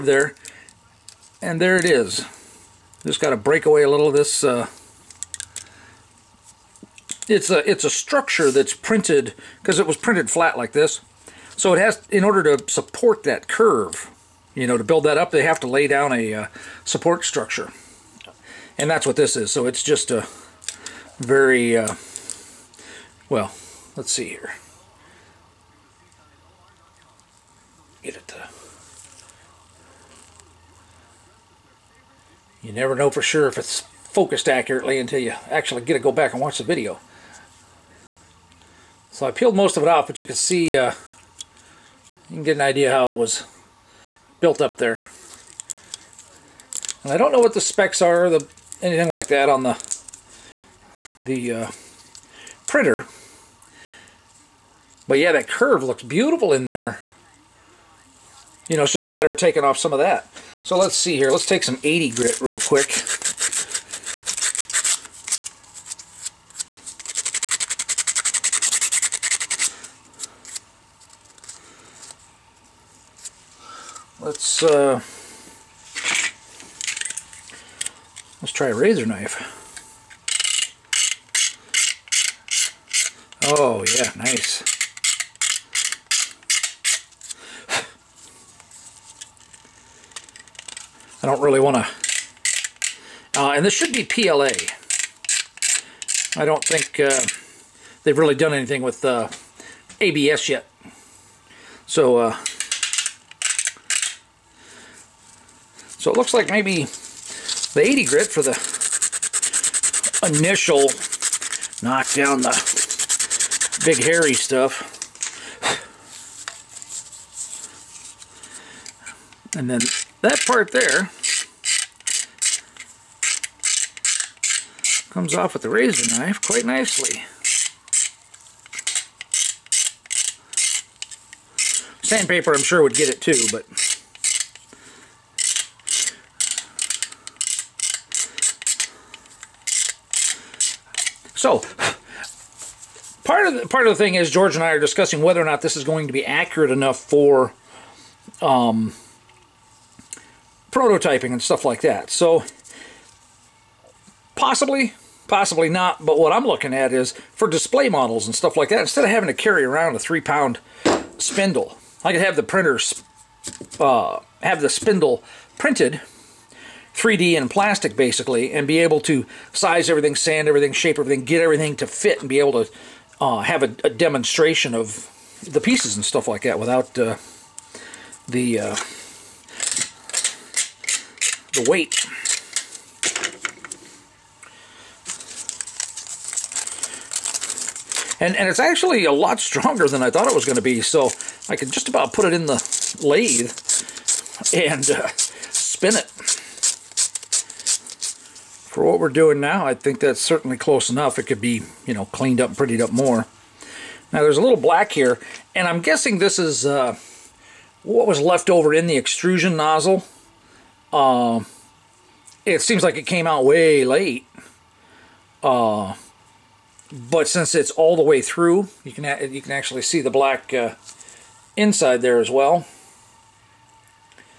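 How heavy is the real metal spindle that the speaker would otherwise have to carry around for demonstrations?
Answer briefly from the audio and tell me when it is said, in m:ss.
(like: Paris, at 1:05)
3 pounds, at 2:39.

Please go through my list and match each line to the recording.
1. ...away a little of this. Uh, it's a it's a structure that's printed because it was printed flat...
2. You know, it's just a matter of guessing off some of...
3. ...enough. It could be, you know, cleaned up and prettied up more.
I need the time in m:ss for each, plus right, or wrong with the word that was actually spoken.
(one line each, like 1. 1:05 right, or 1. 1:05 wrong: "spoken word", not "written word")
1. 0:03 right
2. 0:58 wrong: "taking", not "guessing"
3. 3:20 right.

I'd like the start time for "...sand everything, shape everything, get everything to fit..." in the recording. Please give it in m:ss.
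2:50.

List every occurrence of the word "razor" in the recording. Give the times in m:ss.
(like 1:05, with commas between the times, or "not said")
1:18, 2:05.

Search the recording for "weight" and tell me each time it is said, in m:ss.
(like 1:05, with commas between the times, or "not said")
3:01.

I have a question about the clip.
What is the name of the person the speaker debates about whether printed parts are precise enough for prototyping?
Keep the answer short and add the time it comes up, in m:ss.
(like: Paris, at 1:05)
George, at 2:24.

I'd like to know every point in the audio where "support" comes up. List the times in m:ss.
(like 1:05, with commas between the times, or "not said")
0:12, 0:16.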